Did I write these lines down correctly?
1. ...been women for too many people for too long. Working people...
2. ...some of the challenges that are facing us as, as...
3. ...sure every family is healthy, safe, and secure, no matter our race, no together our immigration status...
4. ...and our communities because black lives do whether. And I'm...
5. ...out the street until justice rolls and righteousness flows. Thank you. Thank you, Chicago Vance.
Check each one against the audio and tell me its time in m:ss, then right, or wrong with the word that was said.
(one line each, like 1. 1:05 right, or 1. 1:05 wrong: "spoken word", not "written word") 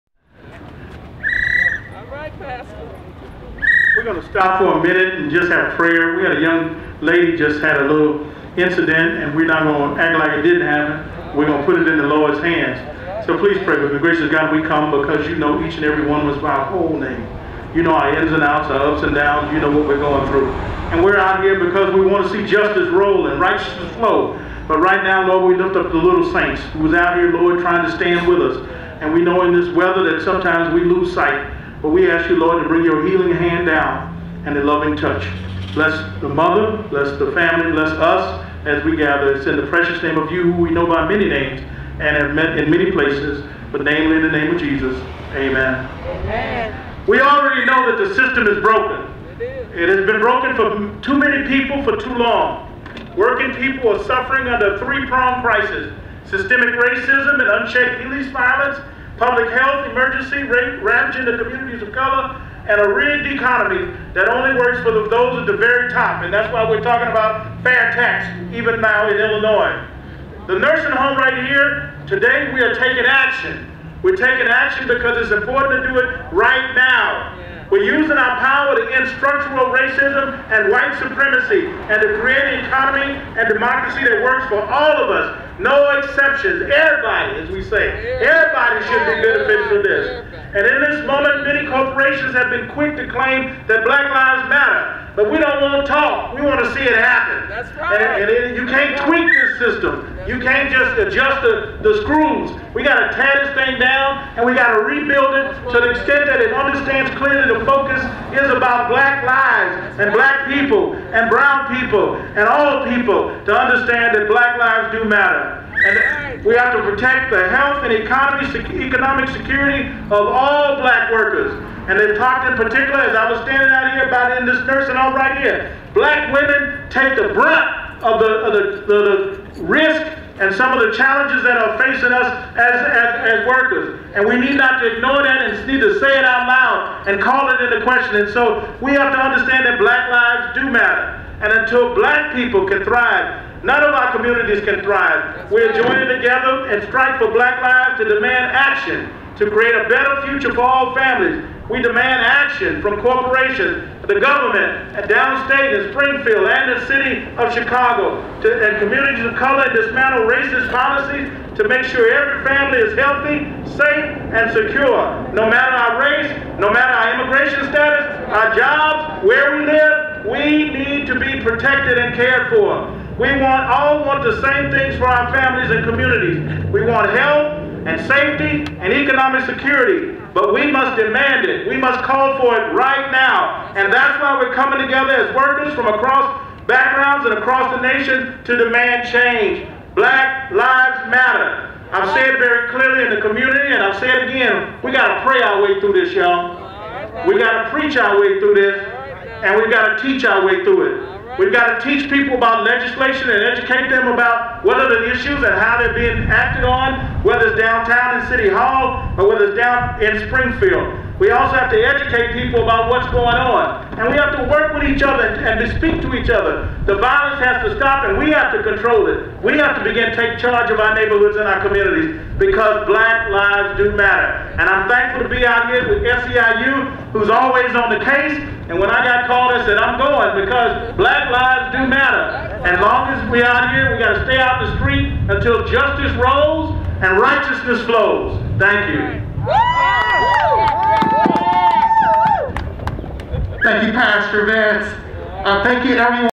1. 0:50 wrong: "broken", not "women"
2. 2:10 right
3. 2:41 wrong: "matter", not "together"
4. 3:41 wrong: "matter", not "whether"
5. 3:54 wrong: "Pastor", not "Chicago".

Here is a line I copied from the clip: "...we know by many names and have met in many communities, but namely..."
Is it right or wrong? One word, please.
wrong.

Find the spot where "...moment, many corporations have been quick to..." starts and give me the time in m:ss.
1:31.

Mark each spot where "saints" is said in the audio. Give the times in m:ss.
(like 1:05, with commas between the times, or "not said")
0:26.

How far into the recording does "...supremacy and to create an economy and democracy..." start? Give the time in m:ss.
1:20.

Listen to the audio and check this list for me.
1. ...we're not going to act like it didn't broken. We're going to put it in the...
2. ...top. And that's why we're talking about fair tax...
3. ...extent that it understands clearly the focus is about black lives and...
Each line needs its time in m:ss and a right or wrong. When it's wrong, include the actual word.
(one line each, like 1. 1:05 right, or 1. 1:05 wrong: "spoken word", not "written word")
1. 0:09 wrong: "happen", not "broken"
2. 1:05 right
3. 1:45 right.